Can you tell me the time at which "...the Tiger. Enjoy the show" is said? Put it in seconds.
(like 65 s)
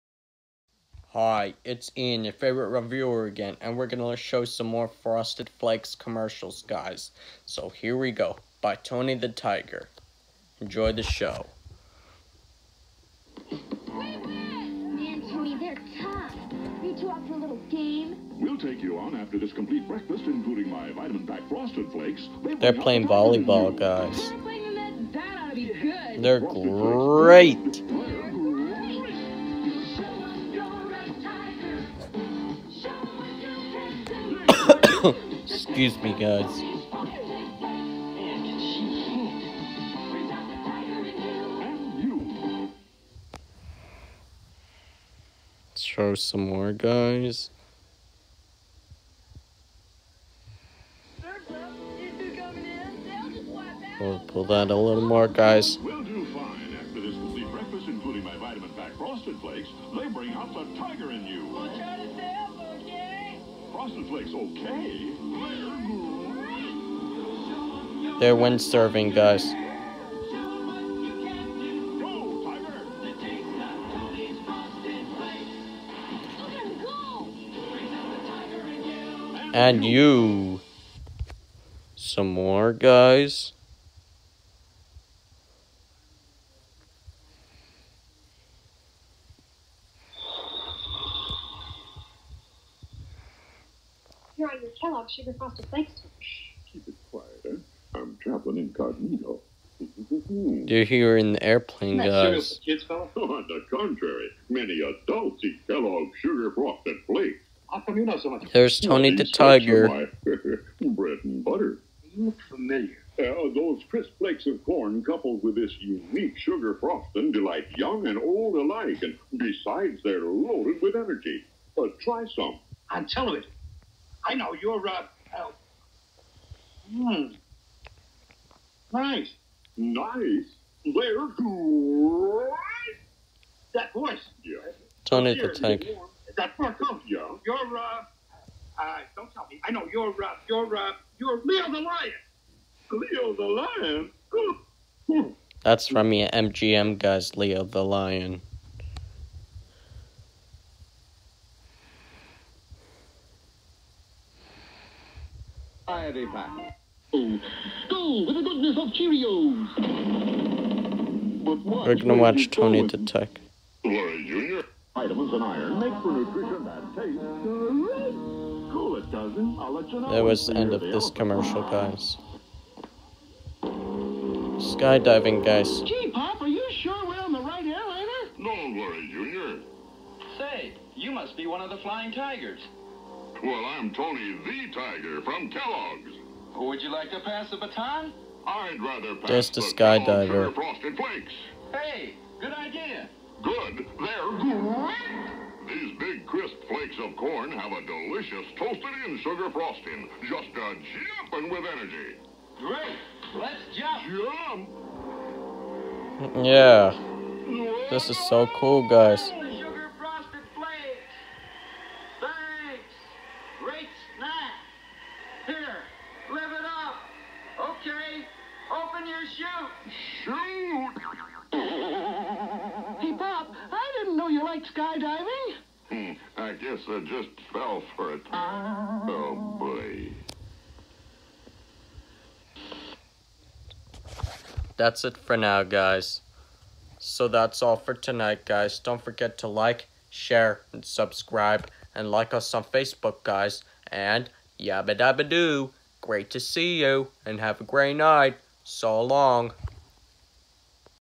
9 s.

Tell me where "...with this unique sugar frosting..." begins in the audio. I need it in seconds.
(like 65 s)
115 s.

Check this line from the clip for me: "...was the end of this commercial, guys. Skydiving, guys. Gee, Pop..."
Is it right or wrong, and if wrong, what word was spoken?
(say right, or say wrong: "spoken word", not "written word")
right.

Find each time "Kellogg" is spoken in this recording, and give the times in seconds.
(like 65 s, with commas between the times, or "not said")
94 s, 105 s, 185 s.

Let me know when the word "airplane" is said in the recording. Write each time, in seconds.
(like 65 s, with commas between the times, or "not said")
101 s.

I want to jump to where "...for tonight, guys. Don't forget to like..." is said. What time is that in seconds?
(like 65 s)
237 s.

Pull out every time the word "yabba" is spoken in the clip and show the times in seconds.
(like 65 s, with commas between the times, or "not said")
244 s.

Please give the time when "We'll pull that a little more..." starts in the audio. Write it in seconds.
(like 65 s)
53 s.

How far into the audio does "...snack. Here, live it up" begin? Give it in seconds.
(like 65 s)
214 s.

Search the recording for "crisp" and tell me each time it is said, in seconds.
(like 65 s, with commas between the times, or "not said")
113 s, 196 s.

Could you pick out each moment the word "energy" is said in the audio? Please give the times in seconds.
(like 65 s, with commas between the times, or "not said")
120 s, 201 s.